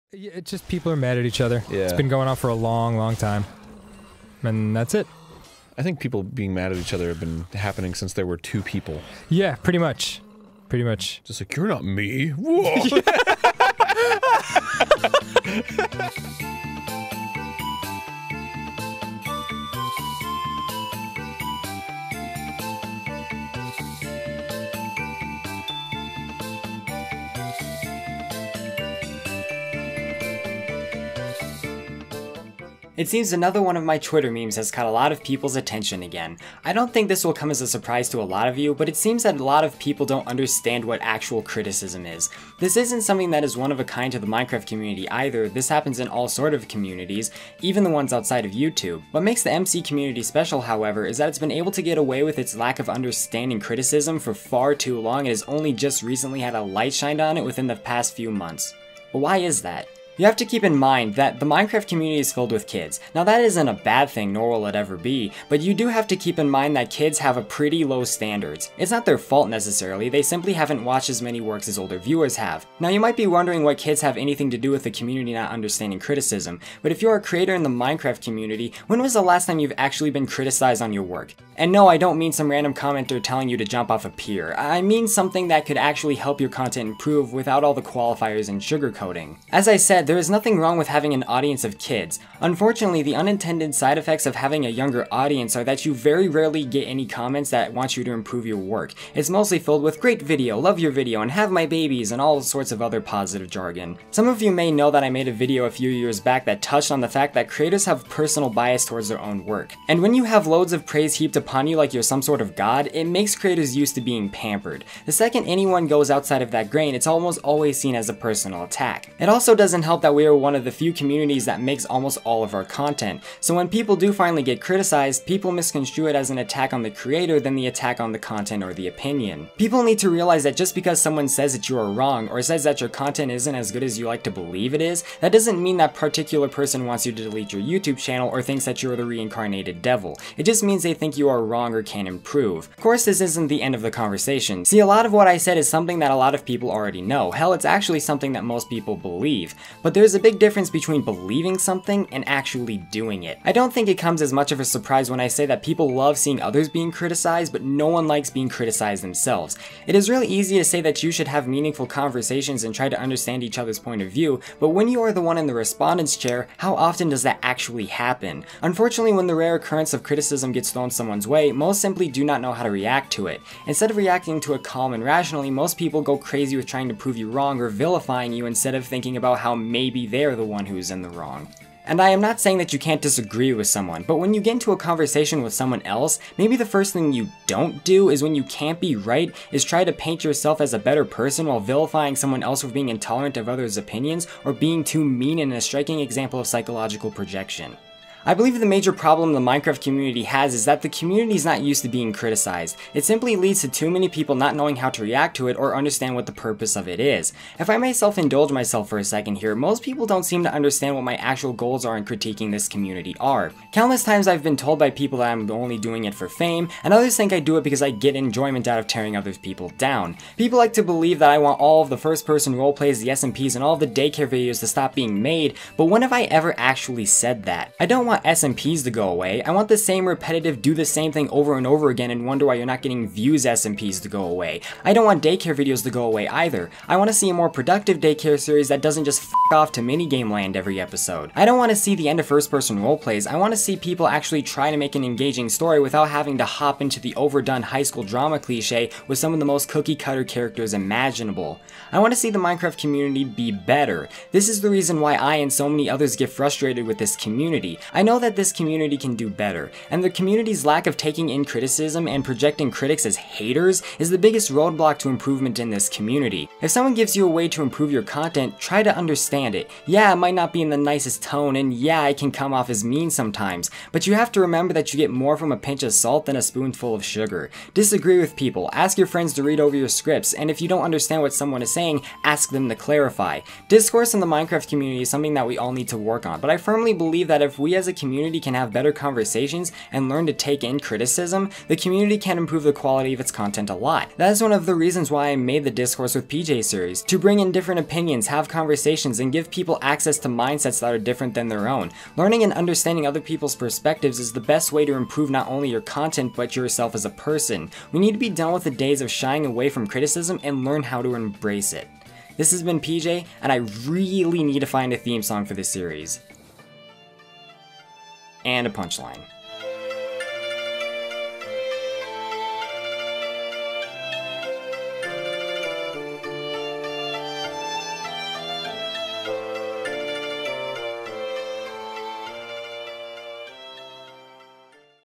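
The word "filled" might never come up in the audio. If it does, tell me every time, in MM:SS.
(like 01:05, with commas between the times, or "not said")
01:02, 01:39.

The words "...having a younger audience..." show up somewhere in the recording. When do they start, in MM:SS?
01:34.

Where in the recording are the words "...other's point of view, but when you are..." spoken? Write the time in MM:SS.
02:43.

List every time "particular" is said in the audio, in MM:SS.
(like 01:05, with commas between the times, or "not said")
02:15.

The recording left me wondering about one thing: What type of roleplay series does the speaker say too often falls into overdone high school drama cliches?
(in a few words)
first person roleplays.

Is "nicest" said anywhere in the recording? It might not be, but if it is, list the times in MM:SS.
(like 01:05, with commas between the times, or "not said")
04:30.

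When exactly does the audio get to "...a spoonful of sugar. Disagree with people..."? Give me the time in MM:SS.
04:36.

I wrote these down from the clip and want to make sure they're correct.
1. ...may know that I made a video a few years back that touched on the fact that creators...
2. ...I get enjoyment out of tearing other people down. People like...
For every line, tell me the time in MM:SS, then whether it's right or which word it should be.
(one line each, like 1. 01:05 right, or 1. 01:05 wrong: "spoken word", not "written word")
1. 01:44 right
2. 03:37 right.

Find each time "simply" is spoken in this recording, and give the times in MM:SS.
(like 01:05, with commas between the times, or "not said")
01:10, 02:51, 03:23.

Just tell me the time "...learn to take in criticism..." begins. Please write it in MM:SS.
04:50.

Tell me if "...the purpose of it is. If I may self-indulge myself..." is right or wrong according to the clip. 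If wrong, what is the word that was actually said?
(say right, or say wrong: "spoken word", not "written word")
right.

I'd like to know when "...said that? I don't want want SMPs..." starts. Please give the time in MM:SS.
03:47.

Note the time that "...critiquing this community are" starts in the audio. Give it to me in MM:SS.
03:32.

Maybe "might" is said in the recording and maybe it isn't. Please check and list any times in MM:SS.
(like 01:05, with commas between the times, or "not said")
01:12, 04:30.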